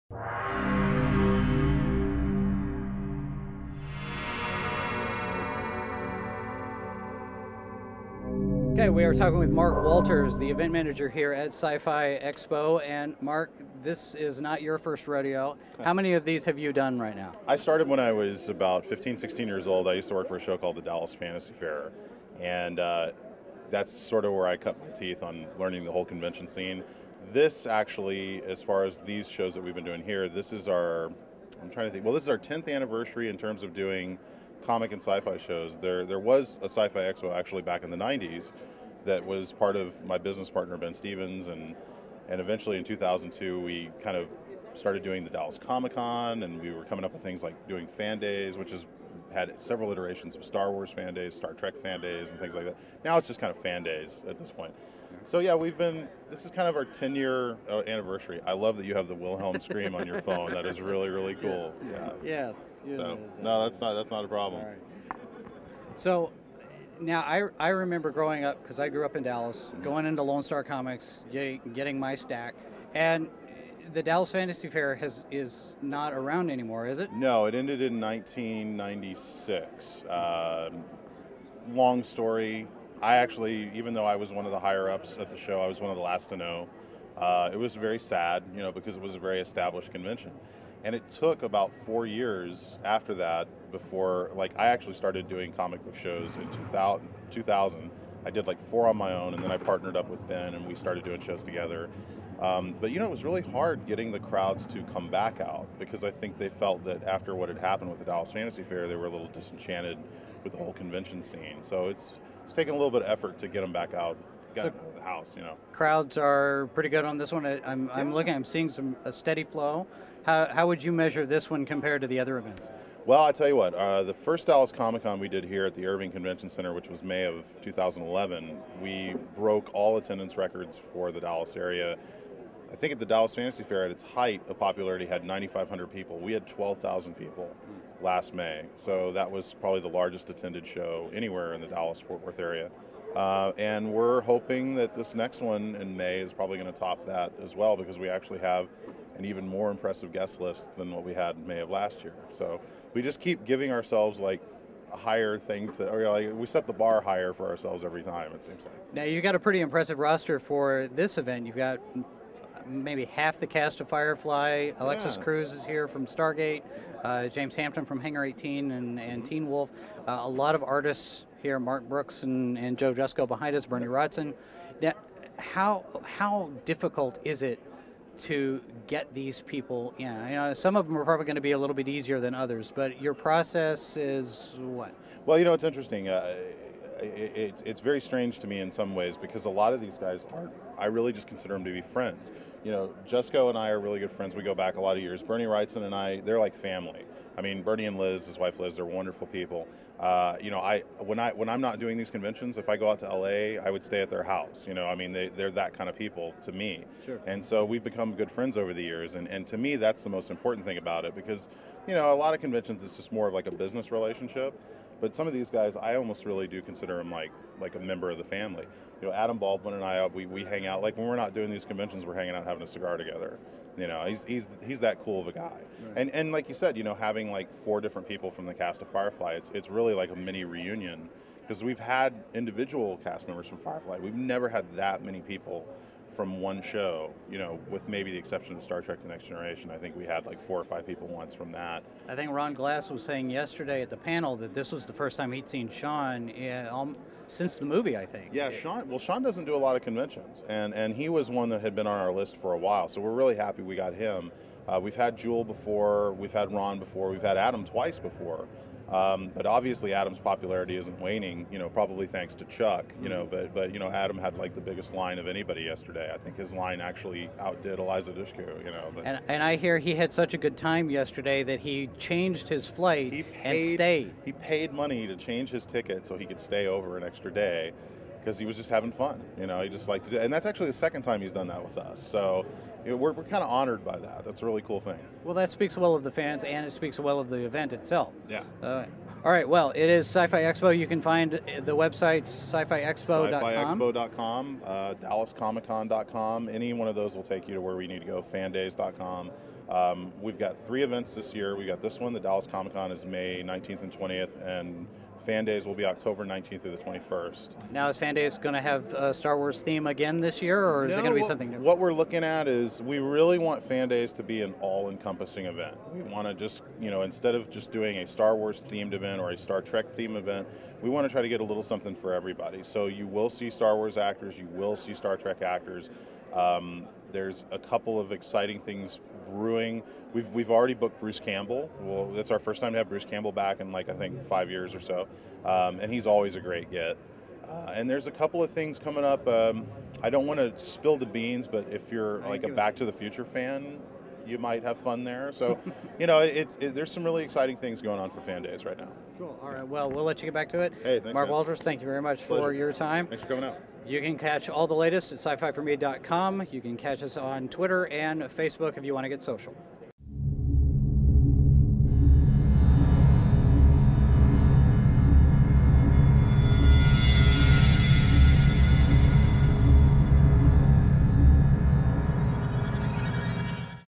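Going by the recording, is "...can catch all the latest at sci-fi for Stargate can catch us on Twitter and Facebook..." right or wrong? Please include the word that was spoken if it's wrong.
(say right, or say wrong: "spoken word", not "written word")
wrong: "You", not "Stargate".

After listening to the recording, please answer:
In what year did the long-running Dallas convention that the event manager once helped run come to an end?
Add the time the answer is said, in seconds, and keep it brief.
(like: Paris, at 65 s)
1996, at 77 s.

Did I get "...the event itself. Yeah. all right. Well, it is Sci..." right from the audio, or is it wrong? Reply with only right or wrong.
right.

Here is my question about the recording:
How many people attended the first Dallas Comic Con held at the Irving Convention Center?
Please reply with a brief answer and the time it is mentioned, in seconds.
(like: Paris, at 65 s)
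12,000, at 136 s.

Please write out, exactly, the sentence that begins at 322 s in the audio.
So you will see Star Wars actors, you will see Star Trek actors.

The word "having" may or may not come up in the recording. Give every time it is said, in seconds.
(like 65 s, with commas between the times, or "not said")
222 s, 226 s, 278 s.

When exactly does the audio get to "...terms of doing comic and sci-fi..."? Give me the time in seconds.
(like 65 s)
33 s.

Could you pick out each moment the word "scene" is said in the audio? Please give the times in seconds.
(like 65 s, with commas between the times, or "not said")
26 s, 111 s.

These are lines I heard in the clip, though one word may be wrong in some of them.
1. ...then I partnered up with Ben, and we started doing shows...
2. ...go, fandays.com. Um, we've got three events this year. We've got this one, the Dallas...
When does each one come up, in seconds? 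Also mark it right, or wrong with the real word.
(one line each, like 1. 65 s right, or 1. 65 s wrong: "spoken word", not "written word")
1. 99 s right
2. 298 s right.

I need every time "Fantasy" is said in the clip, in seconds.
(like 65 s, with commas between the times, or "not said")
21 s, 74 s, 108 s, 133 s.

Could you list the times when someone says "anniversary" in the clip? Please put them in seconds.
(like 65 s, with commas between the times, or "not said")
32 s, 57 s.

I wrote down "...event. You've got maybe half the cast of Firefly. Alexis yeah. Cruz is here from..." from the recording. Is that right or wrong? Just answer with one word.
right.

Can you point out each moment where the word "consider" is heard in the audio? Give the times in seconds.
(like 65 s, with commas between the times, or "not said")
191 s, 216 s.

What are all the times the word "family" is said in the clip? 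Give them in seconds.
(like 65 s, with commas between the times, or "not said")
196 s, 218 s.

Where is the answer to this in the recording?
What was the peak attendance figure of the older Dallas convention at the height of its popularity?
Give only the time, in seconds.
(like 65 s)
135 s.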